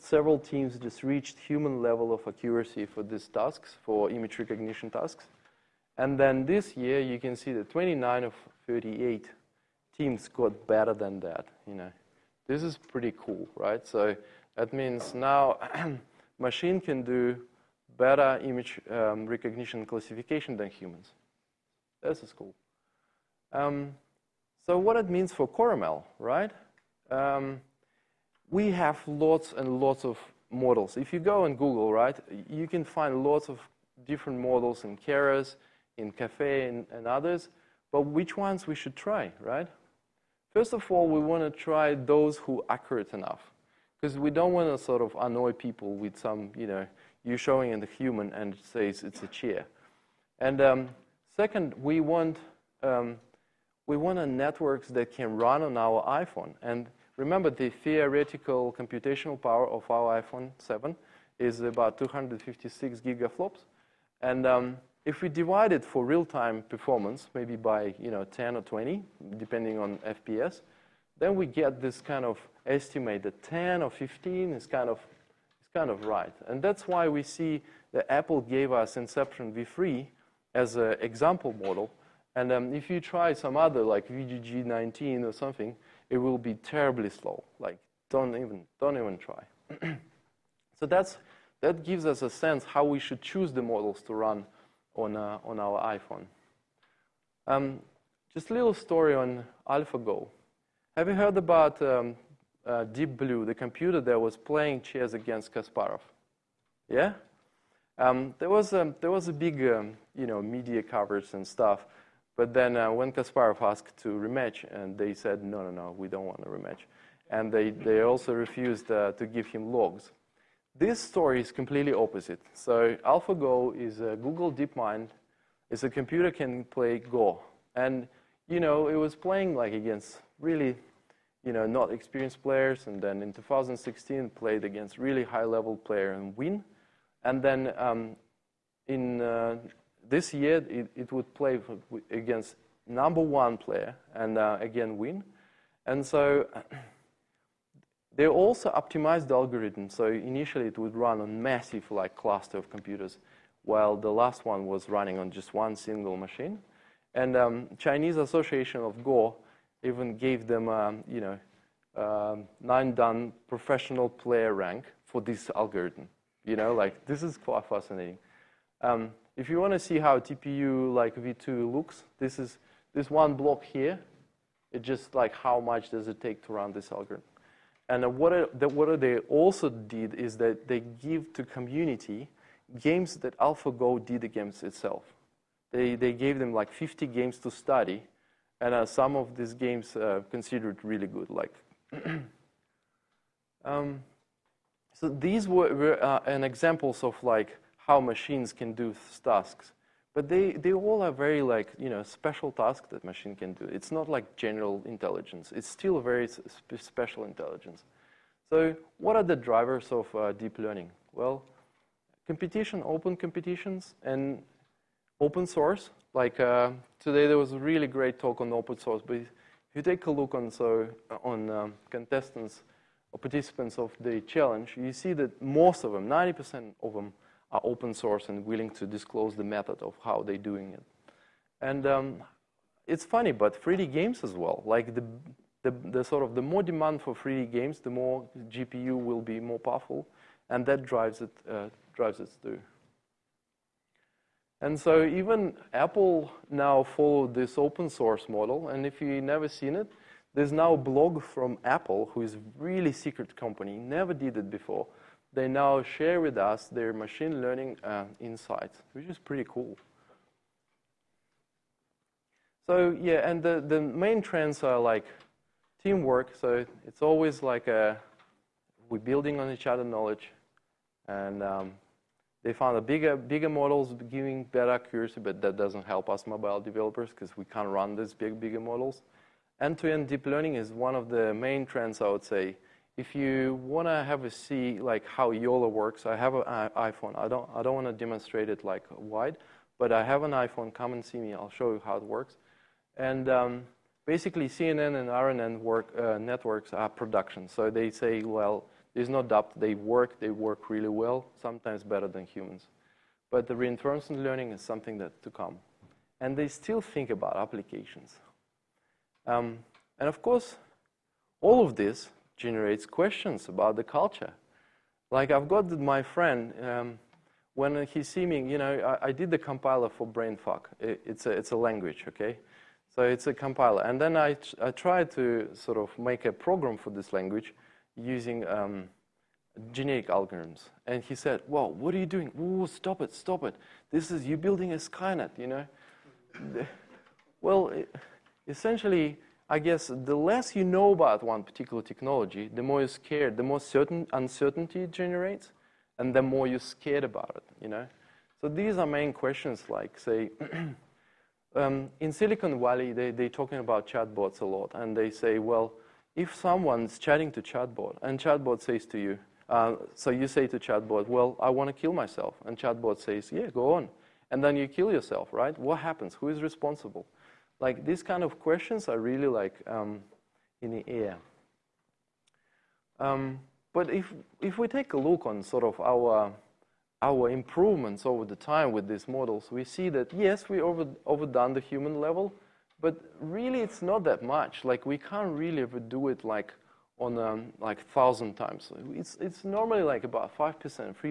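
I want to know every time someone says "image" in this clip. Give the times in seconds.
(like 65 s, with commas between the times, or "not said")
4 s, 18 s.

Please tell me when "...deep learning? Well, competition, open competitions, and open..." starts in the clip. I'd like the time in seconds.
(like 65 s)
210 s.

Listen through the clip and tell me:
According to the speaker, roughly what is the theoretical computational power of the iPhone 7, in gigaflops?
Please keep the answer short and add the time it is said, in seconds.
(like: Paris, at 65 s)
256, at 61 s.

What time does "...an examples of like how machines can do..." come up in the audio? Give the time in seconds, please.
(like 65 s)
196 s.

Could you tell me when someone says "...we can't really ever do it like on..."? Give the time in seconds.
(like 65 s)
384 s.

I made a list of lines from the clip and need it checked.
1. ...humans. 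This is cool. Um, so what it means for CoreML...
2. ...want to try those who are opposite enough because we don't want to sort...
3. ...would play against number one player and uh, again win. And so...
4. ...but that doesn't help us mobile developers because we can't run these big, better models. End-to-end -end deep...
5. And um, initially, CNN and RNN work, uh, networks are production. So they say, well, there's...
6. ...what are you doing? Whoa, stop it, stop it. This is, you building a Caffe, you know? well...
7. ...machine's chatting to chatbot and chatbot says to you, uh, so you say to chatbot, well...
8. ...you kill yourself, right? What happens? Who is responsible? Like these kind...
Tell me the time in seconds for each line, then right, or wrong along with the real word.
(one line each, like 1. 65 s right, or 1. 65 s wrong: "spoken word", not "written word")
1. 20 s right
2. 41 s wrong: "accurate", not "opposite"
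3. 141 s right
4. 275 s wrong: "bigger", not "better"
5. 292 s wrong: "basically", not "initially"
6. 331 s wrong: "Skynet", not "Caffe"
7. 356 s wrong: "someone", not "machine"
8. 364 s right.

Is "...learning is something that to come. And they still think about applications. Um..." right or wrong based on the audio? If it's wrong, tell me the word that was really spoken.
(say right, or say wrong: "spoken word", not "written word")
right.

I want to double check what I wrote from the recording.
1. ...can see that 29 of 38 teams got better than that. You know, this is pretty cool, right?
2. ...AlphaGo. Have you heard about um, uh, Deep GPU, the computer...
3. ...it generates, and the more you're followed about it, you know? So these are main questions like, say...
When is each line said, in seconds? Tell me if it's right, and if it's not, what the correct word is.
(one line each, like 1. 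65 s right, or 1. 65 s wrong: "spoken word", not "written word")
1. 7 s right
2. 99 s wrong: "Blue", not "GPU"
3. 344 s wrong: "scared", not "followed".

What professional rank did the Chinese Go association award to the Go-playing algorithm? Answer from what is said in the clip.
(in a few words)
nine dan.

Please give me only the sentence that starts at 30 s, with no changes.
If you go on Google, right, you can find lots of different models in Keras, in Caffe, and, and others.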